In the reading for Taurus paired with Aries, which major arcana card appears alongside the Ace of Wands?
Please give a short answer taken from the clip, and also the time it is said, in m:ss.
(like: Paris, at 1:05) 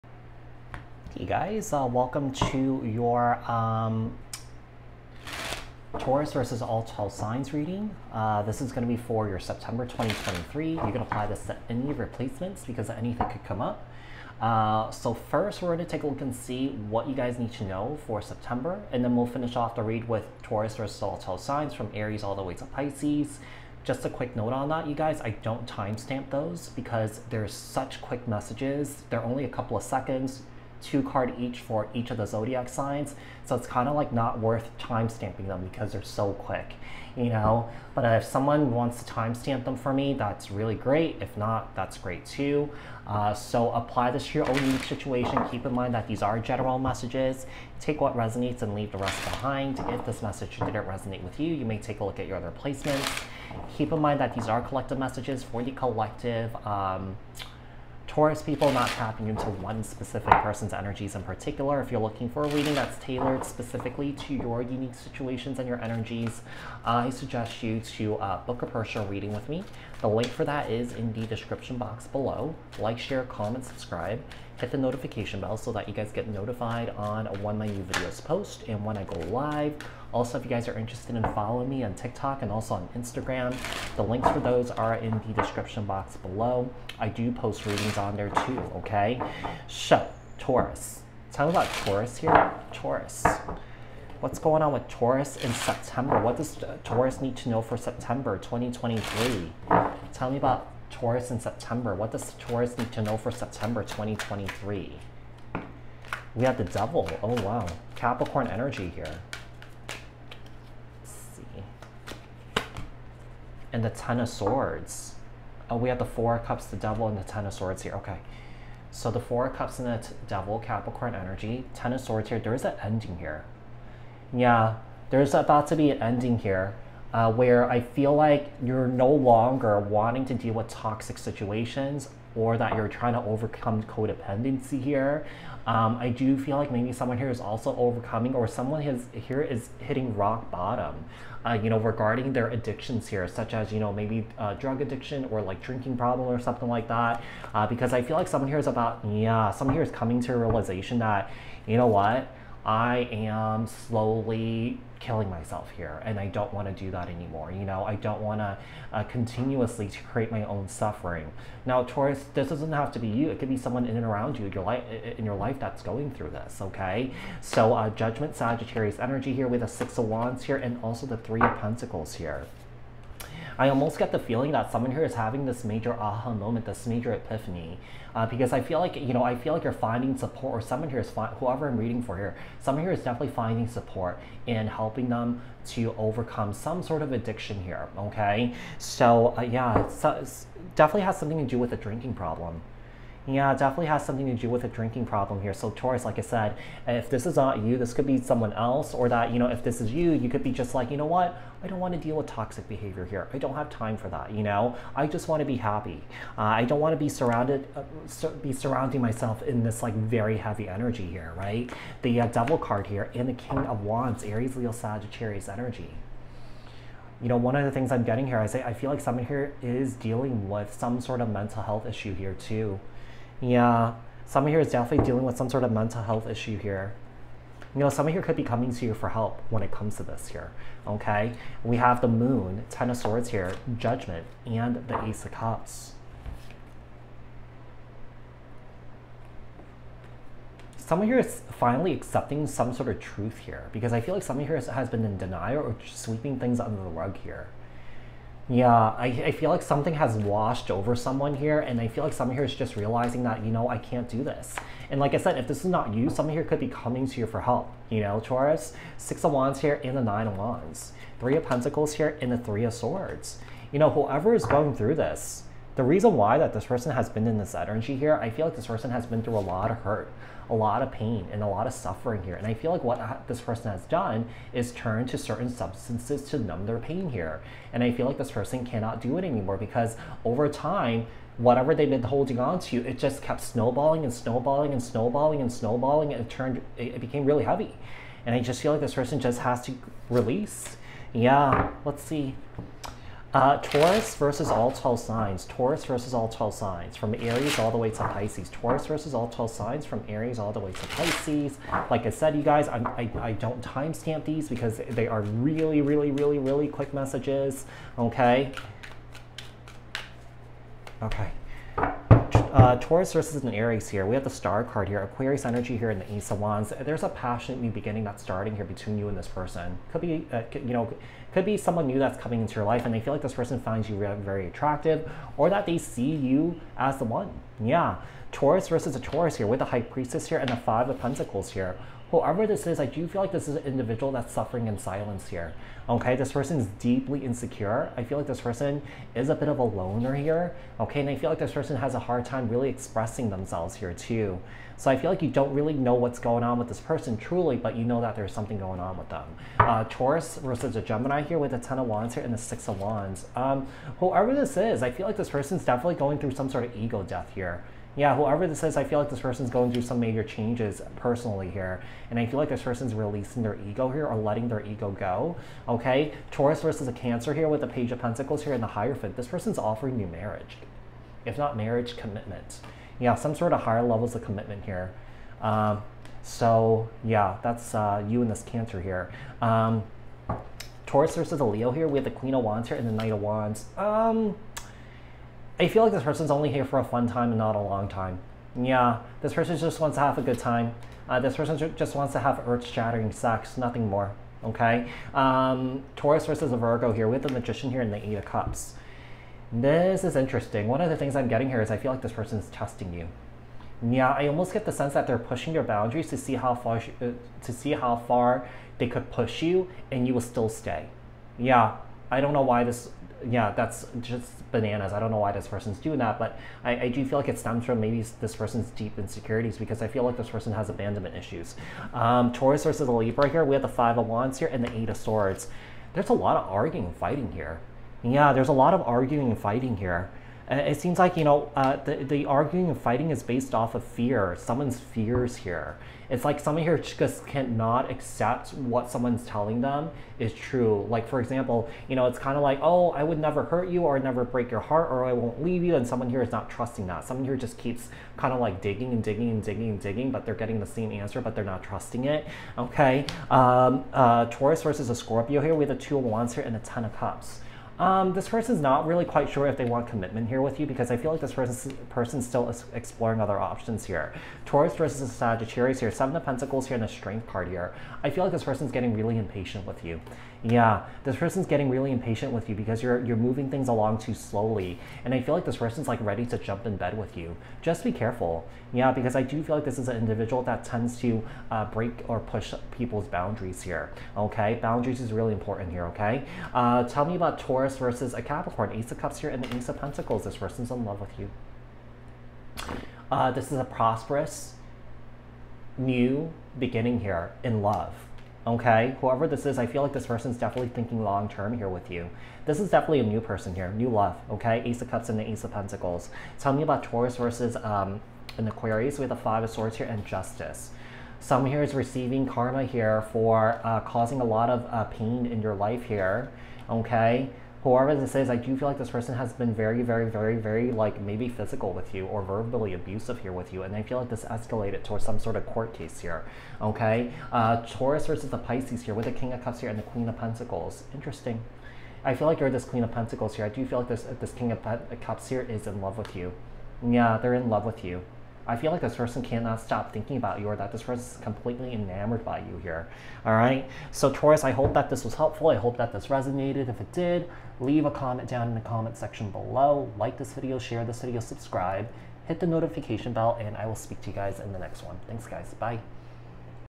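The Star, at 5:14.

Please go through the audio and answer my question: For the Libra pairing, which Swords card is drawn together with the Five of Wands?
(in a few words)
Eight of Swords.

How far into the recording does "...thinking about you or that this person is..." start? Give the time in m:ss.
8:59.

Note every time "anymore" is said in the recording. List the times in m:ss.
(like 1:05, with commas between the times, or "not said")
2:37, 4:39.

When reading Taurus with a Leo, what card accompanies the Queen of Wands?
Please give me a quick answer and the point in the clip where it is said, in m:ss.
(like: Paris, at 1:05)
Knight of Wands, at 6:22.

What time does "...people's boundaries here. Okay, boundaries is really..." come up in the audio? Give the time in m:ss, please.
8:02.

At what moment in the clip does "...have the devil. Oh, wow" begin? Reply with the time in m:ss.
1:46.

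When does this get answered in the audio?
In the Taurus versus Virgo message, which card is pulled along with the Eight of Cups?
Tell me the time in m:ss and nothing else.
6:37.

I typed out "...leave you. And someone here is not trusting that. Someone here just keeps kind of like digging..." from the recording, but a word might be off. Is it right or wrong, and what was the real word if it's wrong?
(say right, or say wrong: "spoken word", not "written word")
right.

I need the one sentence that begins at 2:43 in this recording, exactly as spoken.
It could be someone in and around you your life in your life that's going through this, okay?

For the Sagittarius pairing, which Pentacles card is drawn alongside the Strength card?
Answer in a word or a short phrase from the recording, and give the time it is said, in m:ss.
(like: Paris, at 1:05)
Seven of Pentacles, at 7:45.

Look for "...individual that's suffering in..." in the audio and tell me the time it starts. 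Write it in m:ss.
5:33.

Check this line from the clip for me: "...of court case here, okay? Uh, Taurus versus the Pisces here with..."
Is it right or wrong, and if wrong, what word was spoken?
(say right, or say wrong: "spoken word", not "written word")
right.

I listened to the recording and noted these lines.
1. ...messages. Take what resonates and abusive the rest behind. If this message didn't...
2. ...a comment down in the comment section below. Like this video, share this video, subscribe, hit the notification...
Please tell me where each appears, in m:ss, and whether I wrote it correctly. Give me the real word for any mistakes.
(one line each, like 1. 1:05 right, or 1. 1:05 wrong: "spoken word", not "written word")
1. 0:46 wrong: "leave", not "abusive"
2. 9:07 right.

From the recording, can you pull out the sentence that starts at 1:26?
I do post readings on there too, okay?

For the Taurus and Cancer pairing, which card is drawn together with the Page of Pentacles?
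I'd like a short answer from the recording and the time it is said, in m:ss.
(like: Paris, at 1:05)
The Hierophant, at 6:08.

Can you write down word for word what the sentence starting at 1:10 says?
The link for that is in the description box below.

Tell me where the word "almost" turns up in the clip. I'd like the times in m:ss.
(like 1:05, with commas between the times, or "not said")
2:53, 6:44.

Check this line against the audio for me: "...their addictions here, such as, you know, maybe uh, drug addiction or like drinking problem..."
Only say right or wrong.
right.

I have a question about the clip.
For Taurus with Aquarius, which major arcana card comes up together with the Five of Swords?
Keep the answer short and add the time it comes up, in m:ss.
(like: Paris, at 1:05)
Justice, at 8:30.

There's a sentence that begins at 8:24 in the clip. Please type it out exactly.
Okay, Ace of Cups and the Ace of Pentacles.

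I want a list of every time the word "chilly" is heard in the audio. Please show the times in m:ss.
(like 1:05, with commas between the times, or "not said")
not said.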